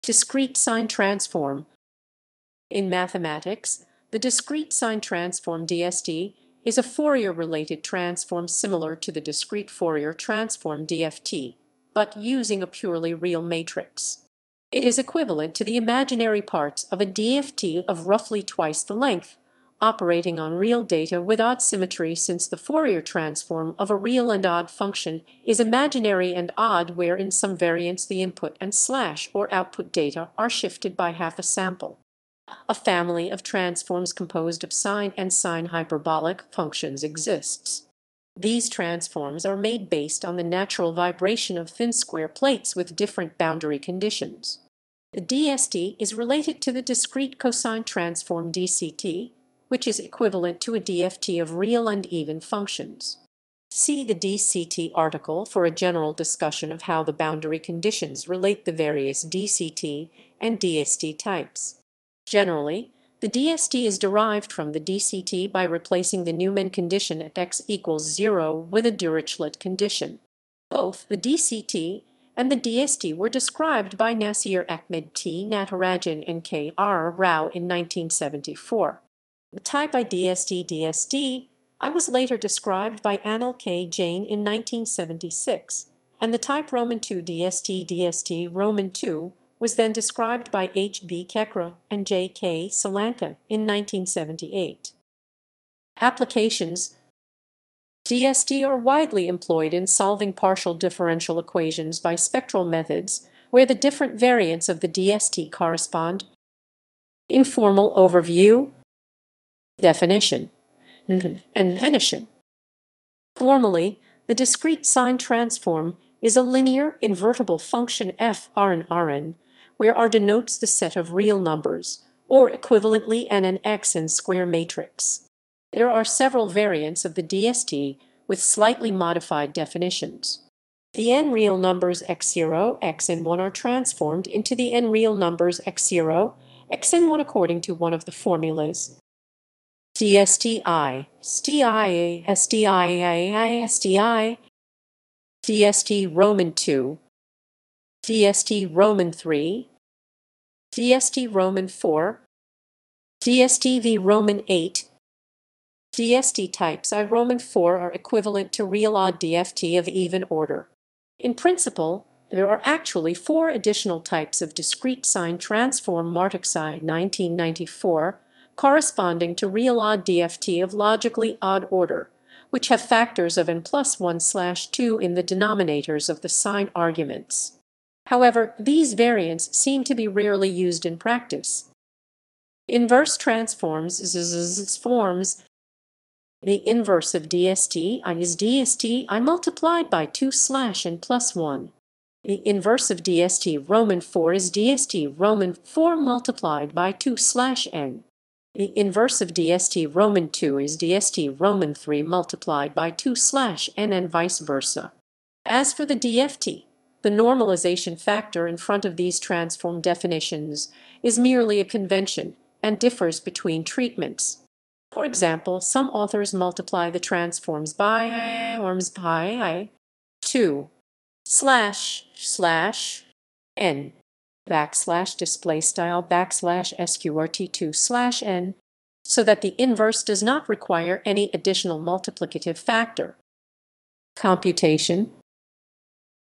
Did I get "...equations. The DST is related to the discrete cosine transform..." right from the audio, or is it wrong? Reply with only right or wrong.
wrong.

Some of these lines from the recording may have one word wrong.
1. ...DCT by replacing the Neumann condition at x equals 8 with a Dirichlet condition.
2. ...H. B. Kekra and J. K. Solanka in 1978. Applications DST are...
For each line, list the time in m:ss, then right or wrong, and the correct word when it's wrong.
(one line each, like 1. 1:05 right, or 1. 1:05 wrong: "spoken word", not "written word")
1. 1:04 wrong: "0", not "8"
2. 1:30 right.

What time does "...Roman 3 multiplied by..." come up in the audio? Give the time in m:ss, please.
3:21.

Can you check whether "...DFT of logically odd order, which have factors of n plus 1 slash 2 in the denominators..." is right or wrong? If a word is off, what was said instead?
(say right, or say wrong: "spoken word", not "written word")
right.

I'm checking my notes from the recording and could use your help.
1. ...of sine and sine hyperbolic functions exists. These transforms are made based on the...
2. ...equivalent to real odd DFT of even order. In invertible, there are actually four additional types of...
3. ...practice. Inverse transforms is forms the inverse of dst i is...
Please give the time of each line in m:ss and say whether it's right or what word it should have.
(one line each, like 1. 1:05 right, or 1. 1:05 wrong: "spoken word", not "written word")
1. 0:34 right
2. 2:37 wrong: "principle", not "invertible"
3. 3:00 right.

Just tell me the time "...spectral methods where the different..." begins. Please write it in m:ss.
1:42.